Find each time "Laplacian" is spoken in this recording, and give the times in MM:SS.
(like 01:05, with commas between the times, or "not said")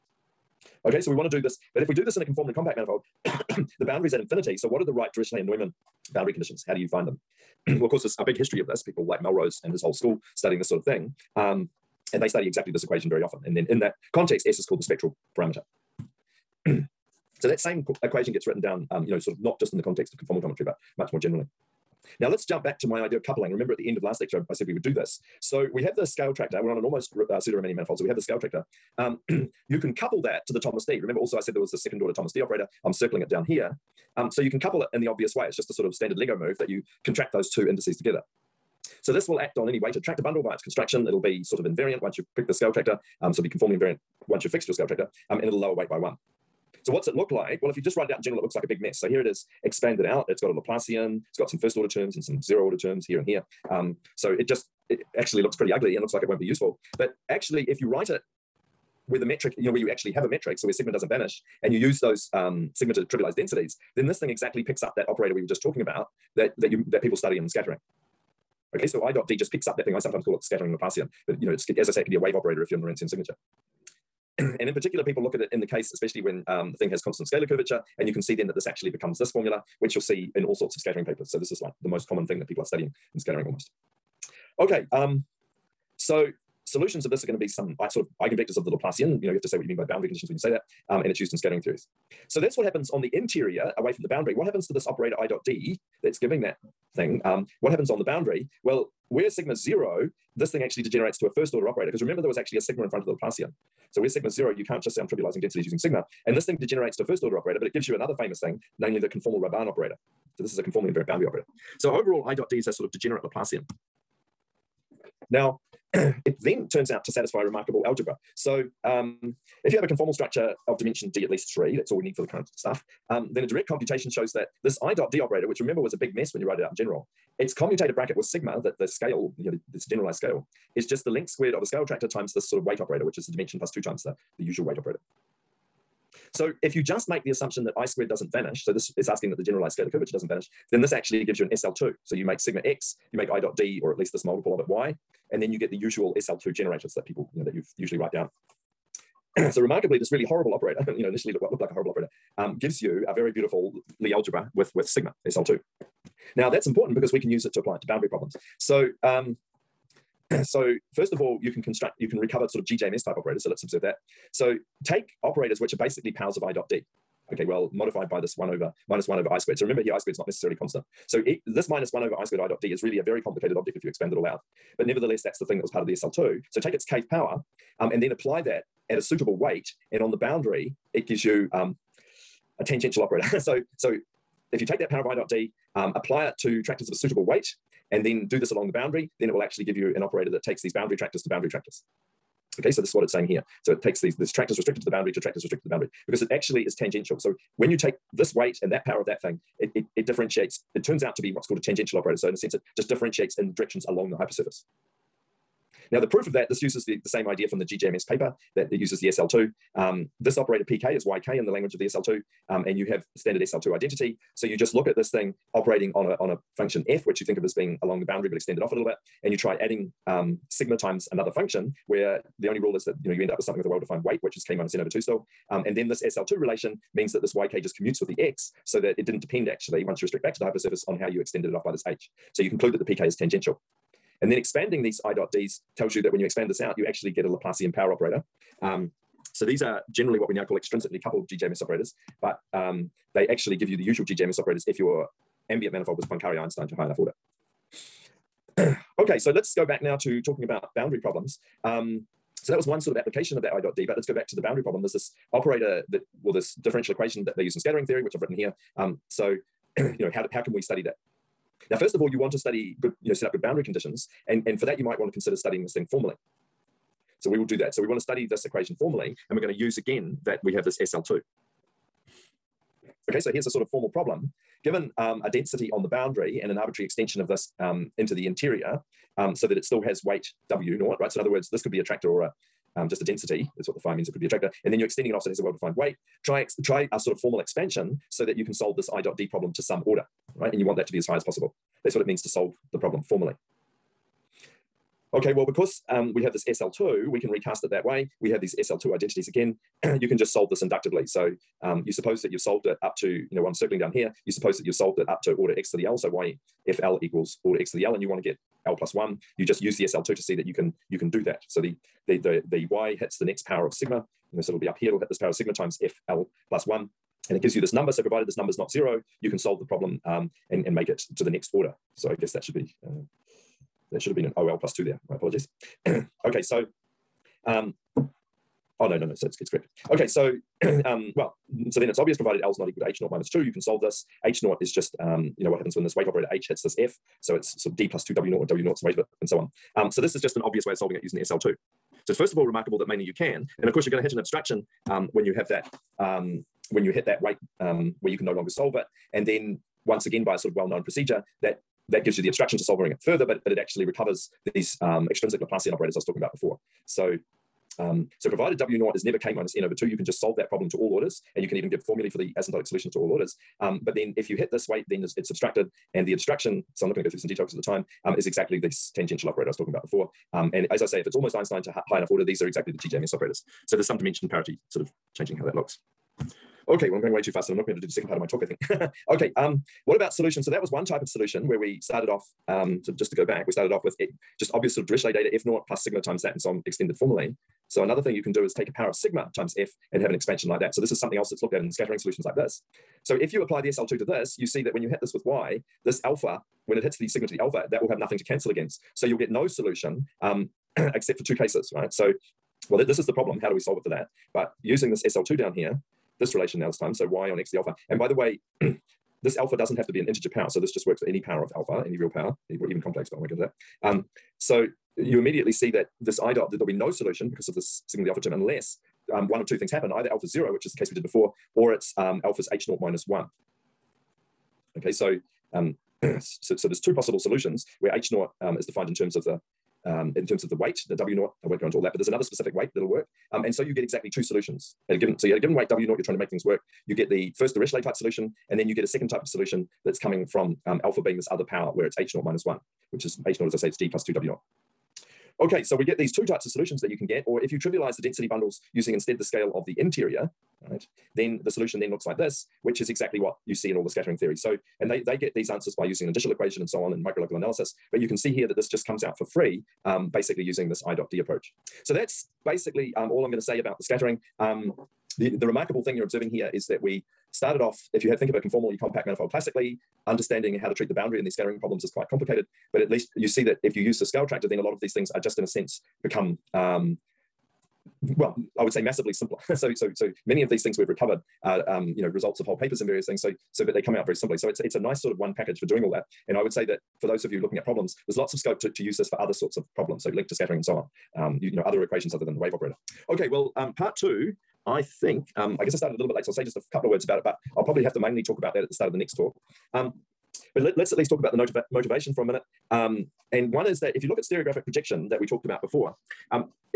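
00:50, 01:10, 01:28, 01:43, 01:53, 03:57, 05:55.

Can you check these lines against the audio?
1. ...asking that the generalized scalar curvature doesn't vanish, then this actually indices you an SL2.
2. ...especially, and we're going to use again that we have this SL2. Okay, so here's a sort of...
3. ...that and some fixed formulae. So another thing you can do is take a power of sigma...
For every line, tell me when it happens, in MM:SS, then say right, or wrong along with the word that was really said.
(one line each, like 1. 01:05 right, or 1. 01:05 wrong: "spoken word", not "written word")
1. 02:19 wrong: "gives", not "indices"
2. 04:28 wrong: "formally", not "especially"
3. 06:26 wrong: "extended", not "fixed".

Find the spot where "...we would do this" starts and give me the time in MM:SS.
00:24.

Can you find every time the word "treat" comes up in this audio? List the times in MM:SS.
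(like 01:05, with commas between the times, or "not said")
07:50.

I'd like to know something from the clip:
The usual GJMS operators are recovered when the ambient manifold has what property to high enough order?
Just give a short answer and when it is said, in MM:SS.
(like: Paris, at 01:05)
Poincare Einstein, at 04:06.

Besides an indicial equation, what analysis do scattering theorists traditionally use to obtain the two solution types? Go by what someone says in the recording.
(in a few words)
microlocal analysis.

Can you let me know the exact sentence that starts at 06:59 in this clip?
Either alpha zero, which is the case we did before, or it's um, alpha's h naught minus one.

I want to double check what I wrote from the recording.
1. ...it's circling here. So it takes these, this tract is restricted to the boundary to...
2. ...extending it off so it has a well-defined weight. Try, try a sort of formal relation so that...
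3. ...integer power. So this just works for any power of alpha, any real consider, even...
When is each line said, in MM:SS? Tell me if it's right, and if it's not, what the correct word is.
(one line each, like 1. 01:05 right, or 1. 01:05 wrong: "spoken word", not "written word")
1. 03:13 wrong: "saying", not "circling"
2. 04:44 wrong: "expansion", not "relation"
3. 06:50 wrong: "power", not "consider".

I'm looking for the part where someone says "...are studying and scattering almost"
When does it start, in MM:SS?
01:22.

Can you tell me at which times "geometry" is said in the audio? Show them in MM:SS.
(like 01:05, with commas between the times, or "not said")
00:20.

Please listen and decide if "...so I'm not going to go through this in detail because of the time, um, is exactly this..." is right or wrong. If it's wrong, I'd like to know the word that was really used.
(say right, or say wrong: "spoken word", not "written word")
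right.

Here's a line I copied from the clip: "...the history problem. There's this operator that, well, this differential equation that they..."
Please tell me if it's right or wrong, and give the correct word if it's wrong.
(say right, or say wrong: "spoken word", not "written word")
wrong: "boundary", not "history".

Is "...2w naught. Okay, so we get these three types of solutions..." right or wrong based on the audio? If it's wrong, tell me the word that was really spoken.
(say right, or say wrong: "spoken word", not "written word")
wrong: "two", not "three".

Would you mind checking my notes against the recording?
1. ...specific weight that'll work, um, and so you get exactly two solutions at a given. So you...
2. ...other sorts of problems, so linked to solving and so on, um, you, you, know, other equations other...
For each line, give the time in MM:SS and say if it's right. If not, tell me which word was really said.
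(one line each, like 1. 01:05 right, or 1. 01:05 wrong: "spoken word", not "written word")
1. 07:12 right
2. 08:09 wrong: "scattering", not "solving".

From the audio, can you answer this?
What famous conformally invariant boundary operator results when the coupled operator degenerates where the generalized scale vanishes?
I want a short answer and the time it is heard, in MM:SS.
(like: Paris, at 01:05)
conformal Robin operator, at 01:49.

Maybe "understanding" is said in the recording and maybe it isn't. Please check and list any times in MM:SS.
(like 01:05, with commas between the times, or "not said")
07:50.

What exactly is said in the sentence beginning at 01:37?
Um, what happens on the boundary?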